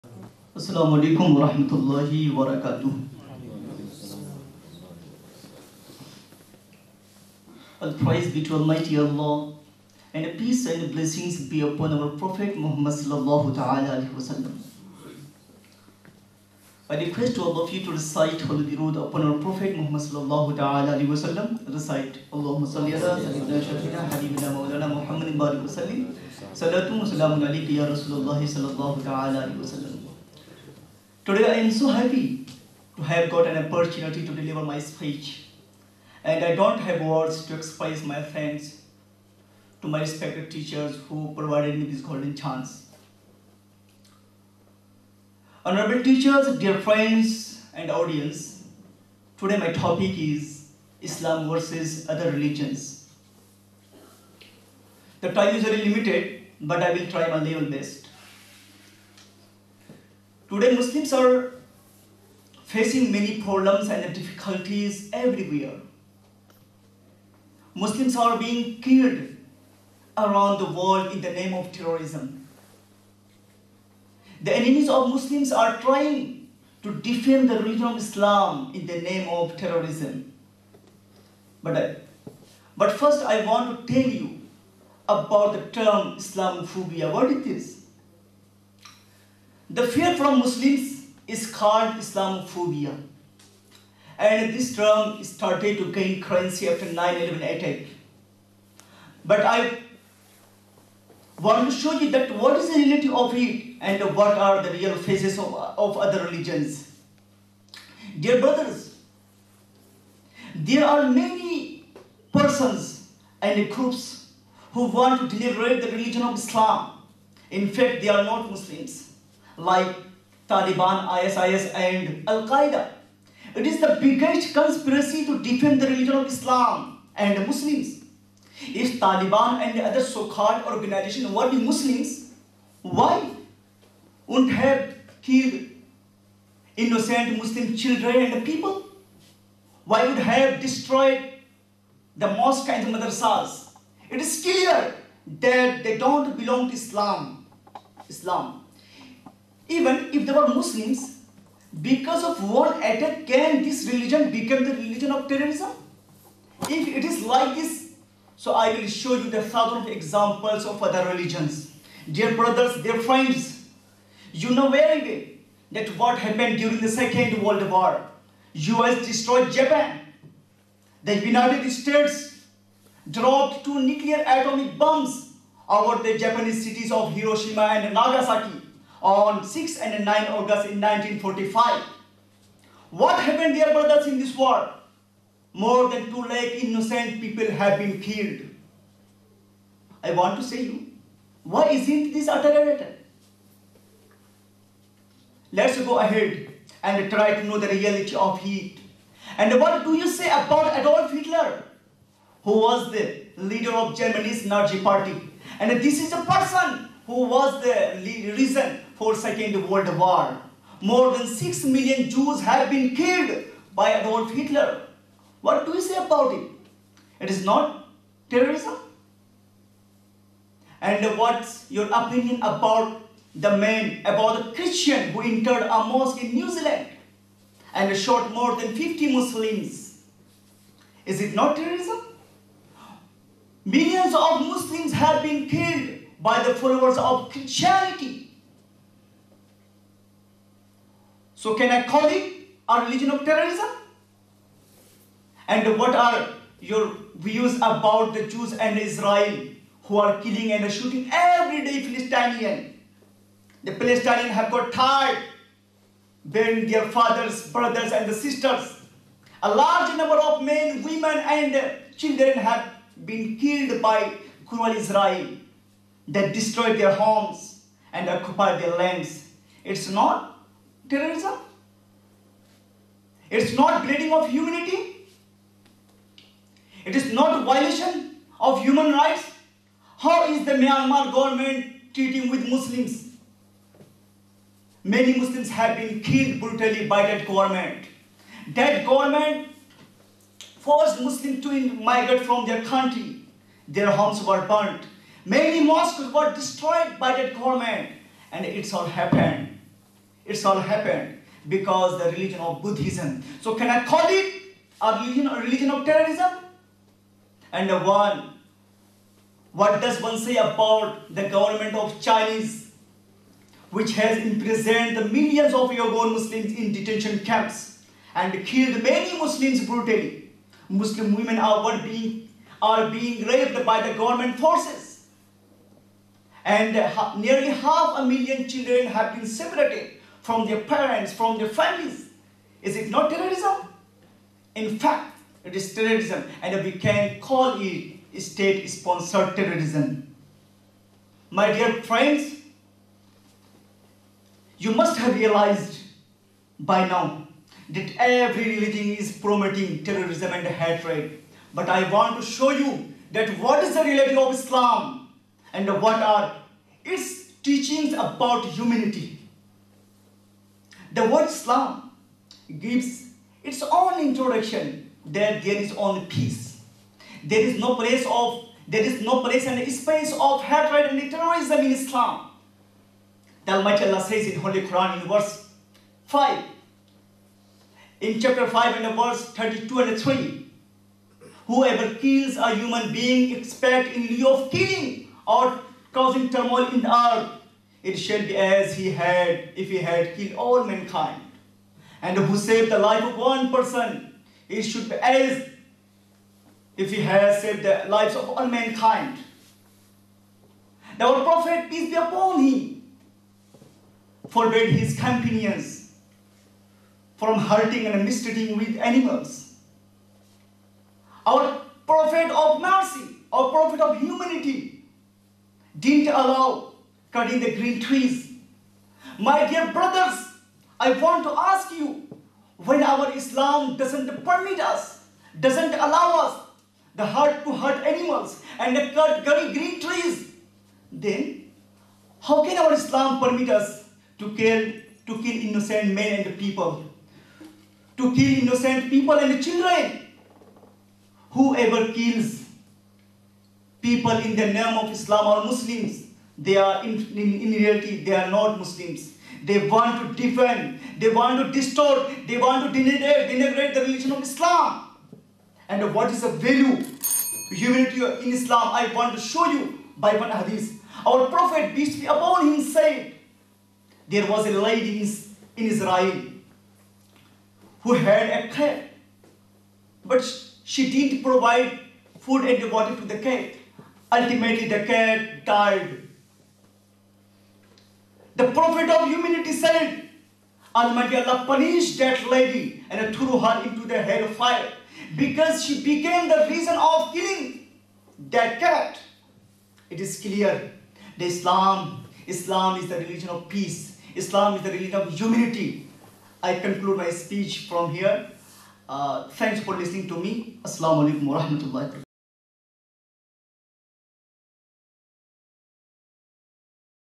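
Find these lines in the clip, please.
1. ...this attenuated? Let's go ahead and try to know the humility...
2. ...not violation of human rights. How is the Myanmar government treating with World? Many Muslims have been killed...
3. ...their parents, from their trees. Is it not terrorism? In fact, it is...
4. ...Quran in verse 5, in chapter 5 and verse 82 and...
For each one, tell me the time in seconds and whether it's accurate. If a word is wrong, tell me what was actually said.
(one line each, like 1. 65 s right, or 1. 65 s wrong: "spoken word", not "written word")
1. 192 s wrong: "reality", not "humility"
2. 277 s wrong: "Muslims", not "World"
3. 330 s wrong: "families", not "trees"
4. 374 s wrong: "32", not "82".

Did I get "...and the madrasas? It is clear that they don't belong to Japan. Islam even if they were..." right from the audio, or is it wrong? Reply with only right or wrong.
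wrong.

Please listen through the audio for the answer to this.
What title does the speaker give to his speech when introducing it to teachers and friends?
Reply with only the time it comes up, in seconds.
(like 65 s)
51 s.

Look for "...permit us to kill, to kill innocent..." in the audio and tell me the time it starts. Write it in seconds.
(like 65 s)
433 s.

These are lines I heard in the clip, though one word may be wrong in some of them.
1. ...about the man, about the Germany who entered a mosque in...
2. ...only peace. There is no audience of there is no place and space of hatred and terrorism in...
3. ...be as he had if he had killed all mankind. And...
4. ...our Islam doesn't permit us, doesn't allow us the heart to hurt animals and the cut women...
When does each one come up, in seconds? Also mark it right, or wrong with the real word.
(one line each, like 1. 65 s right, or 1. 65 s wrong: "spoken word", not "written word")
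1. 222 s wrong: "Christian", not "Germany"
2. 365 s wrong: "place", not "audience"
3. 388 s right
4. 422 s wrong: "green", not "women".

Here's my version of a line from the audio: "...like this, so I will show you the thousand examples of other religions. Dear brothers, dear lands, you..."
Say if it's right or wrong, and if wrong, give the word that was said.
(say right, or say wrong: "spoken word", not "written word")
wrong: "friends", not "lands".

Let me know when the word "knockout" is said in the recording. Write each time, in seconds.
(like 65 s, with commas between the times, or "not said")
not said.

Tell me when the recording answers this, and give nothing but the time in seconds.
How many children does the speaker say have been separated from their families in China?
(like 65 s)
327 s.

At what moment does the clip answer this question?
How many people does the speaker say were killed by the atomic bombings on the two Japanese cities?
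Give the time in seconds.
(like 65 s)
185 s.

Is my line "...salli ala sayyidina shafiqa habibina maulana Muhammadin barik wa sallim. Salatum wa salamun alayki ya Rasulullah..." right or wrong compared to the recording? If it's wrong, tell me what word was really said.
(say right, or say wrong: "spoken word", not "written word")
right.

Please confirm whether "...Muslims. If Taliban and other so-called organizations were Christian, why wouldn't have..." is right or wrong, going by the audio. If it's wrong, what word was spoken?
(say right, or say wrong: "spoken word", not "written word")
wrong: "Muslims", not "Christian".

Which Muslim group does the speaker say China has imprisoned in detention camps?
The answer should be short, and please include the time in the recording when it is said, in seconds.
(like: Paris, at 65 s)
Uyghur Muslims, at 315 s.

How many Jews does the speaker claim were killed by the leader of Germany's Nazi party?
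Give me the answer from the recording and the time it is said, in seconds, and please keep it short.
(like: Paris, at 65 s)
6 million, at 211 s.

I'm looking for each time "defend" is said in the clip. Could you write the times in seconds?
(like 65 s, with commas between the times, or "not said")
76 s, 125 s, 450 s.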